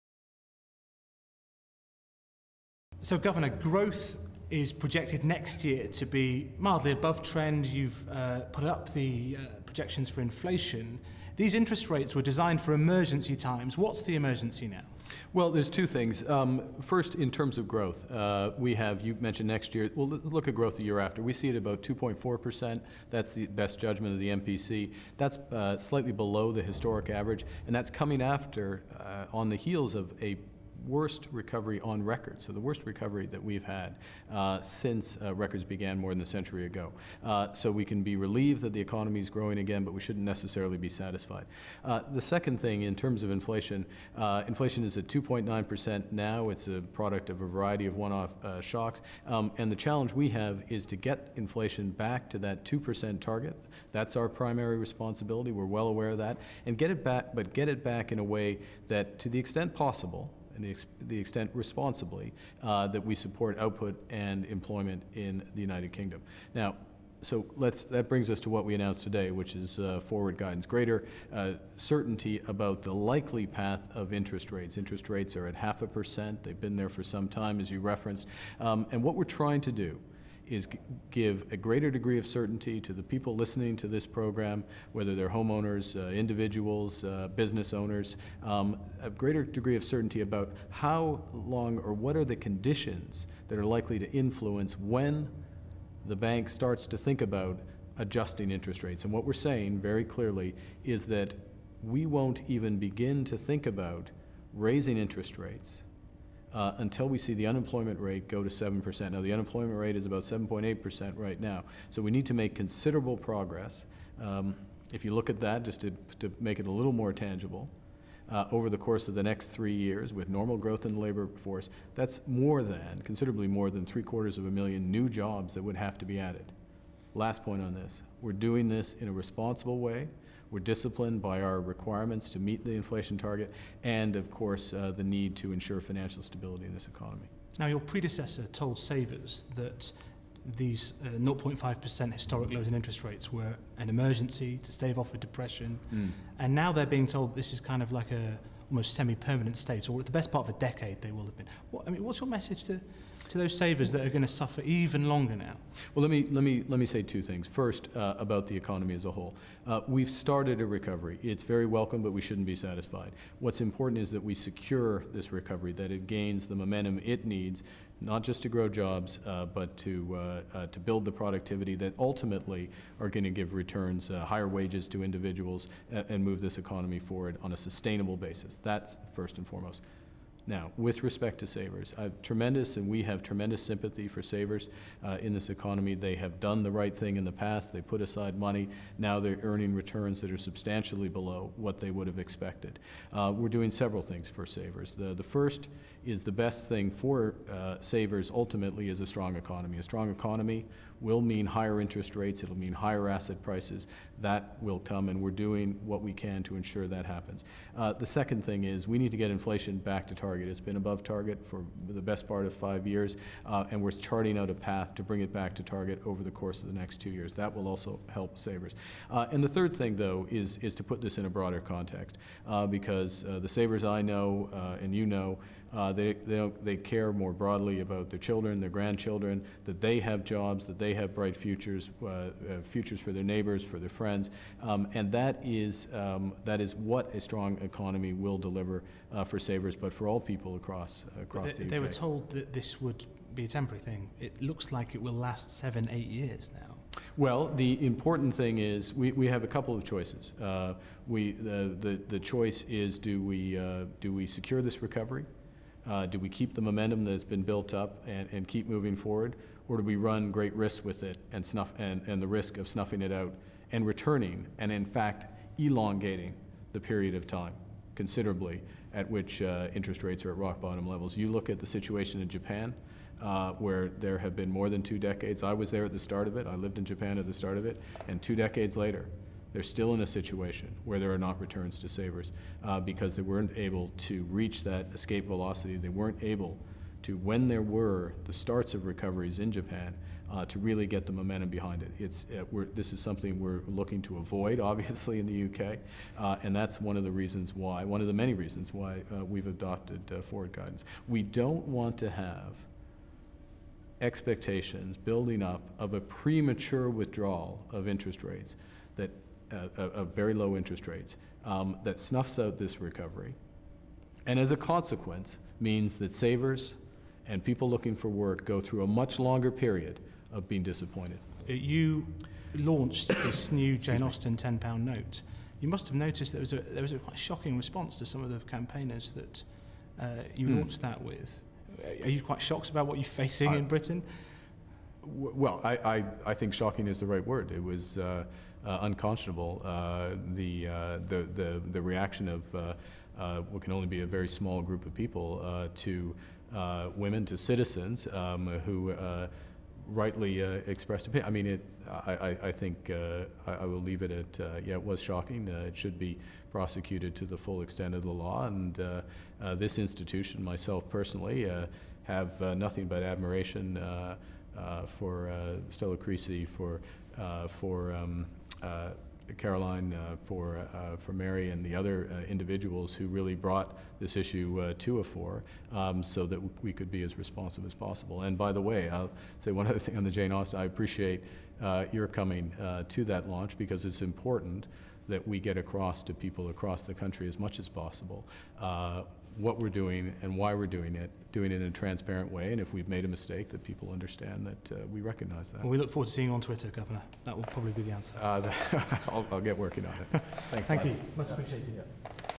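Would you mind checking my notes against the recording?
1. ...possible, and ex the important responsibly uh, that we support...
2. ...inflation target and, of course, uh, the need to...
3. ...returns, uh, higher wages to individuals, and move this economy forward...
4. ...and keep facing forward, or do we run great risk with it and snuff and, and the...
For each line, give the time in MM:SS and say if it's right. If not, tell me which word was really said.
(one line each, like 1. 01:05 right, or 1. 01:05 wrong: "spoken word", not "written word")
1. 00:59 wrong: "extent", not "important"
2. 02:12 right
3. 02:53 right
4. 04:18 wrong: "moving", not "facing".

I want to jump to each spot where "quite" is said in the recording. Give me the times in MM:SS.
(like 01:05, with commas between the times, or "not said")
05:26, 05:32.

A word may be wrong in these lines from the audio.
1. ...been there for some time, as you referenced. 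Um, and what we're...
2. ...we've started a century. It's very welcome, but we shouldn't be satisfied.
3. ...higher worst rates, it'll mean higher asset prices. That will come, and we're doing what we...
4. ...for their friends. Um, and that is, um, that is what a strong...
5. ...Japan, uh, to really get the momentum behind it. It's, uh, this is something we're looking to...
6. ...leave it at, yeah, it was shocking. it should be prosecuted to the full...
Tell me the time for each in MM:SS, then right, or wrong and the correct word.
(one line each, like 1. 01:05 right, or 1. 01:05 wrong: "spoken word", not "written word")
1. 01:16 right
2. 02:39 wrong: "recovery", not "century"
3. 03:21 wrong: "interest", not "worst"
4. 03:53 right
5. 04:49 right
6. 05:53 right.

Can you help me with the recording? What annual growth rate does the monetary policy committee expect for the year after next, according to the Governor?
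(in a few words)
2.4%.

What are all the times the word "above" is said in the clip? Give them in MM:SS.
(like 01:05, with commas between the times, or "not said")
00:06, 03:30.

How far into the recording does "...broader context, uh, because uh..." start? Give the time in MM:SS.
03:41.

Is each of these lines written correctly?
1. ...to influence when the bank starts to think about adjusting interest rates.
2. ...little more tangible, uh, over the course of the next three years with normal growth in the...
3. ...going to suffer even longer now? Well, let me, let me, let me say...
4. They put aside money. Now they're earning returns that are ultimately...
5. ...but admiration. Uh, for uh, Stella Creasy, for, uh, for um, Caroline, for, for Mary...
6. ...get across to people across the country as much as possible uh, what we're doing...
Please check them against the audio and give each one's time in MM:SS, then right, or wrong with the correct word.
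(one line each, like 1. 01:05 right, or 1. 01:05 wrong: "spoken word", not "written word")
1. 01:33 right
2. 01:56 right
3. 02:34 right
4. 03:07 wrong: "substantially", not "ultimately"
5. 06:02 right
6. 06:25 right.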